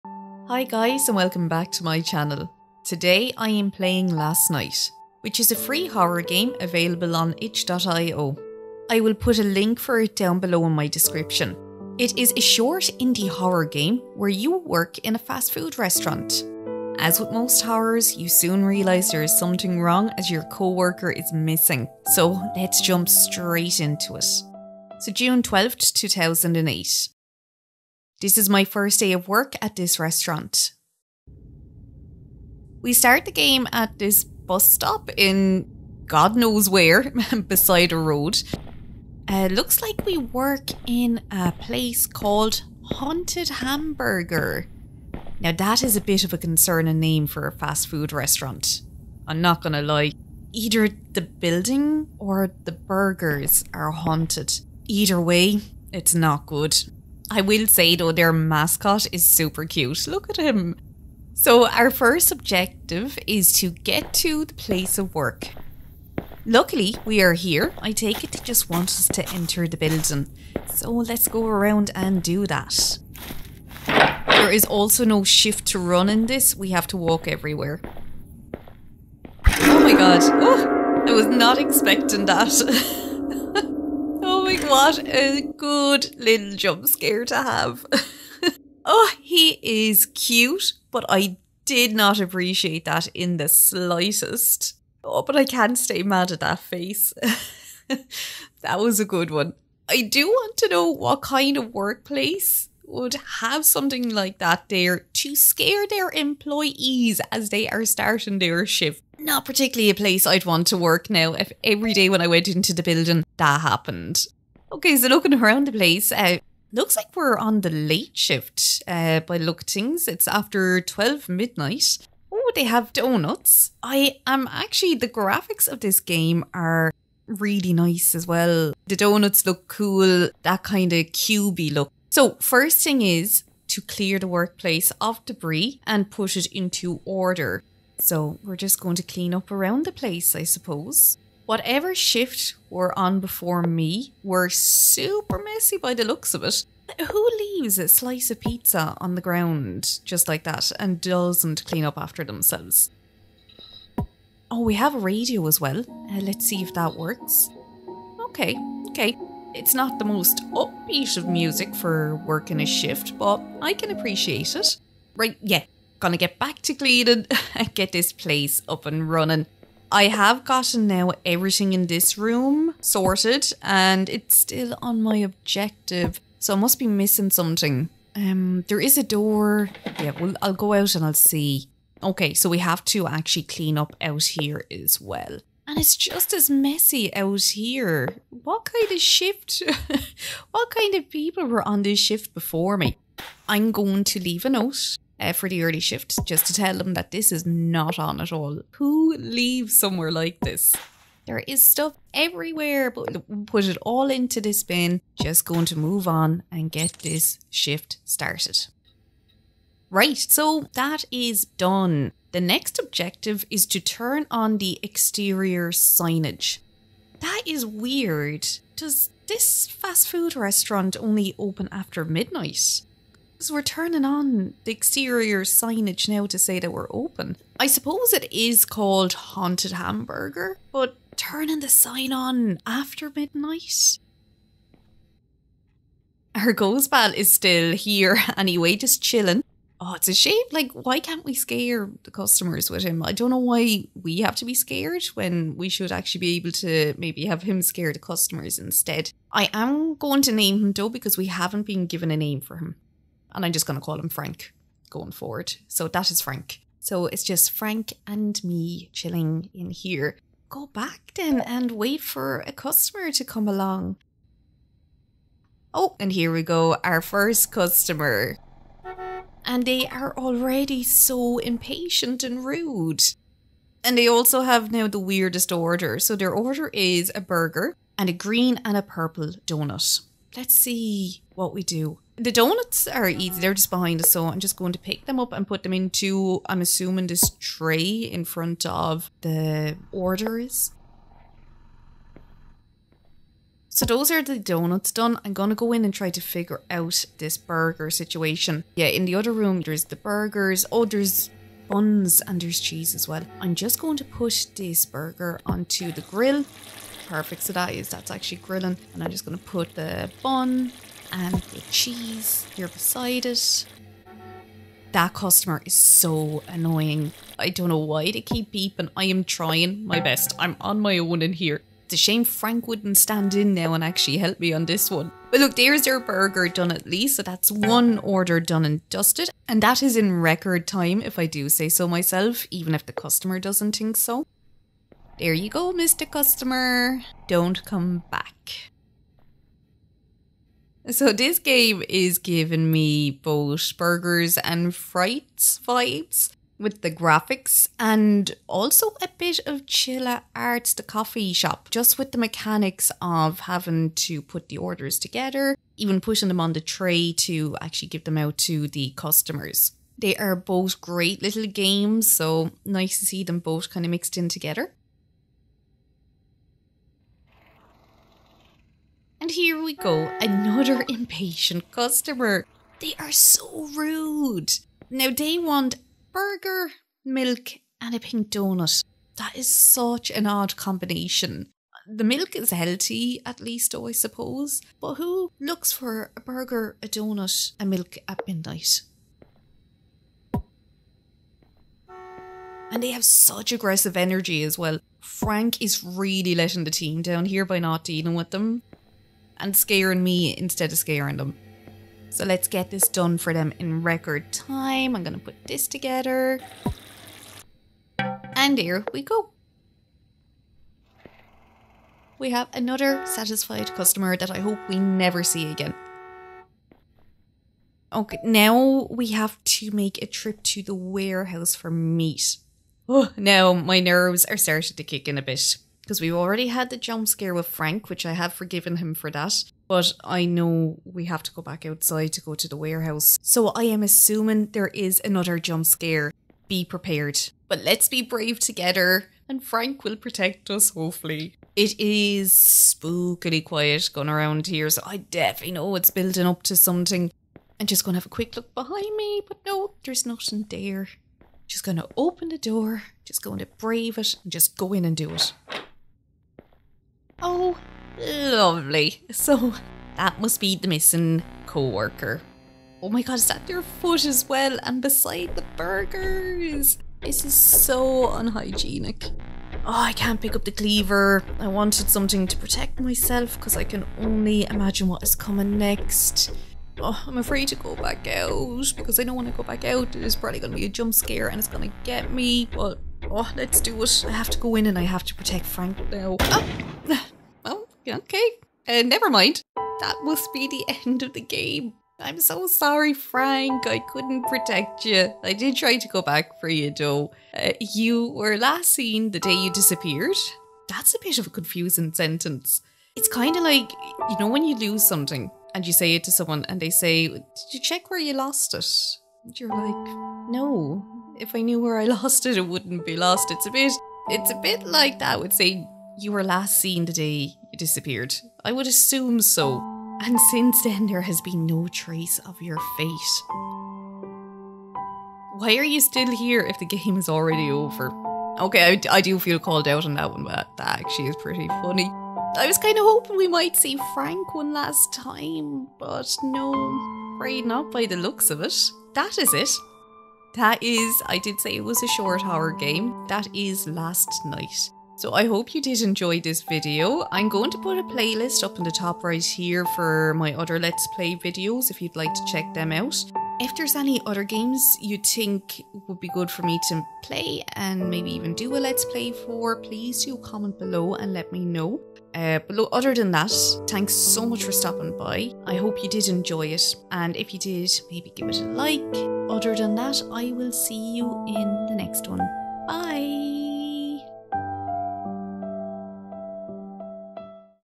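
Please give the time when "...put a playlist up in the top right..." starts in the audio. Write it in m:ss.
9:07.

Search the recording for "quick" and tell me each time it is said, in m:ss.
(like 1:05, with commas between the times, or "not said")
7:28.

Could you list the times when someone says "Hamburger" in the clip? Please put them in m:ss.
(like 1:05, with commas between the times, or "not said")
0:43, 3:49.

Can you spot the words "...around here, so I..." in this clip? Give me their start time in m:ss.
7:24.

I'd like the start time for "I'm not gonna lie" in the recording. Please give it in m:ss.
0:49.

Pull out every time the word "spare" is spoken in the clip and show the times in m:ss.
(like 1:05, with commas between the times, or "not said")
not said.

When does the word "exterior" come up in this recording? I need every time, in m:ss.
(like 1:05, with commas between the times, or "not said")
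3:34, 3:44.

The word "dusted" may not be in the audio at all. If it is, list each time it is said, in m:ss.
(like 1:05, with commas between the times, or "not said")
5:28.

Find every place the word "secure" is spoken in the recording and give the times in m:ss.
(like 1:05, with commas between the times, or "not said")
not said.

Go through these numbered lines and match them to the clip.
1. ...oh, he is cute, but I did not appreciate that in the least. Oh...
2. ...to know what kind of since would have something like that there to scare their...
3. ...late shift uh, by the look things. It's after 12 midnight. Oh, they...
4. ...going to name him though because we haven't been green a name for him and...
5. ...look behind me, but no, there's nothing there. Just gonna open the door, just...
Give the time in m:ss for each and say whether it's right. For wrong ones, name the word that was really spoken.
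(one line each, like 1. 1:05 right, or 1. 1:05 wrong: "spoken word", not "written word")
1. 1:28 wrong: "slightest", not "least"
2. 1:40 wrong: "workplace", not "since"
3. 1:57 right
4. 4:09 wrong: "given", not "green"
5. 7:28 right.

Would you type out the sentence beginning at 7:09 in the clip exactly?
But I know we have to go back outside to go to the warehouse.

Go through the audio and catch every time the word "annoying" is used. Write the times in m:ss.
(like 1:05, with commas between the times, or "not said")
5:16.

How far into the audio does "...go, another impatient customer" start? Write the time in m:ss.
6:09.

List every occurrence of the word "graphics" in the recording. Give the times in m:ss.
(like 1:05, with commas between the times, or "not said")
2:05, 5:46.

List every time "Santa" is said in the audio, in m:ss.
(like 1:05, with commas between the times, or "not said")
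not said.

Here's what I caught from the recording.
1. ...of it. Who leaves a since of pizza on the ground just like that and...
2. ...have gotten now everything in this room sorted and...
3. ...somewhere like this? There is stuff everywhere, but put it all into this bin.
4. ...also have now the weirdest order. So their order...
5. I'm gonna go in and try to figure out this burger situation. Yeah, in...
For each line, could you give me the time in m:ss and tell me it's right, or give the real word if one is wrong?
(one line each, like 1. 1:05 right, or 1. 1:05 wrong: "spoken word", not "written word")
1. 2:26 wrong: "slice", not "since"
2. 2:50 right
3. 3:19 right
4. 4:34 right
5. 4:55 right.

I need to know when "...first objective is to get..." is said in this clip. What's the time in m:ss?
1:01.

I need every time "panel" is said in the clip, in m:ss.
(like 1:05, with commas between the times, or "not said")
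not said.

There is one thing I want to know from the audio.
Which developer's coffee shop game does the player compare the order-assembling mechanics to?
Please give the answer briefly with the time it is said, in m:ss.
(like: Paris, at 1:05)
Chilla's Art, at 5:49.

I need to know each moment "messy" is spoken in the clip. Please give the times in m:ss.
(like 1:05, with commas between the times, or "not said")
2:25, 3:06.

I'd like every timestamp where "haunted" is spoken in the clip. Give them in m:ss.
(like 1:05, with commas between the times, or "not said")
0:42, 0:53, 3:49.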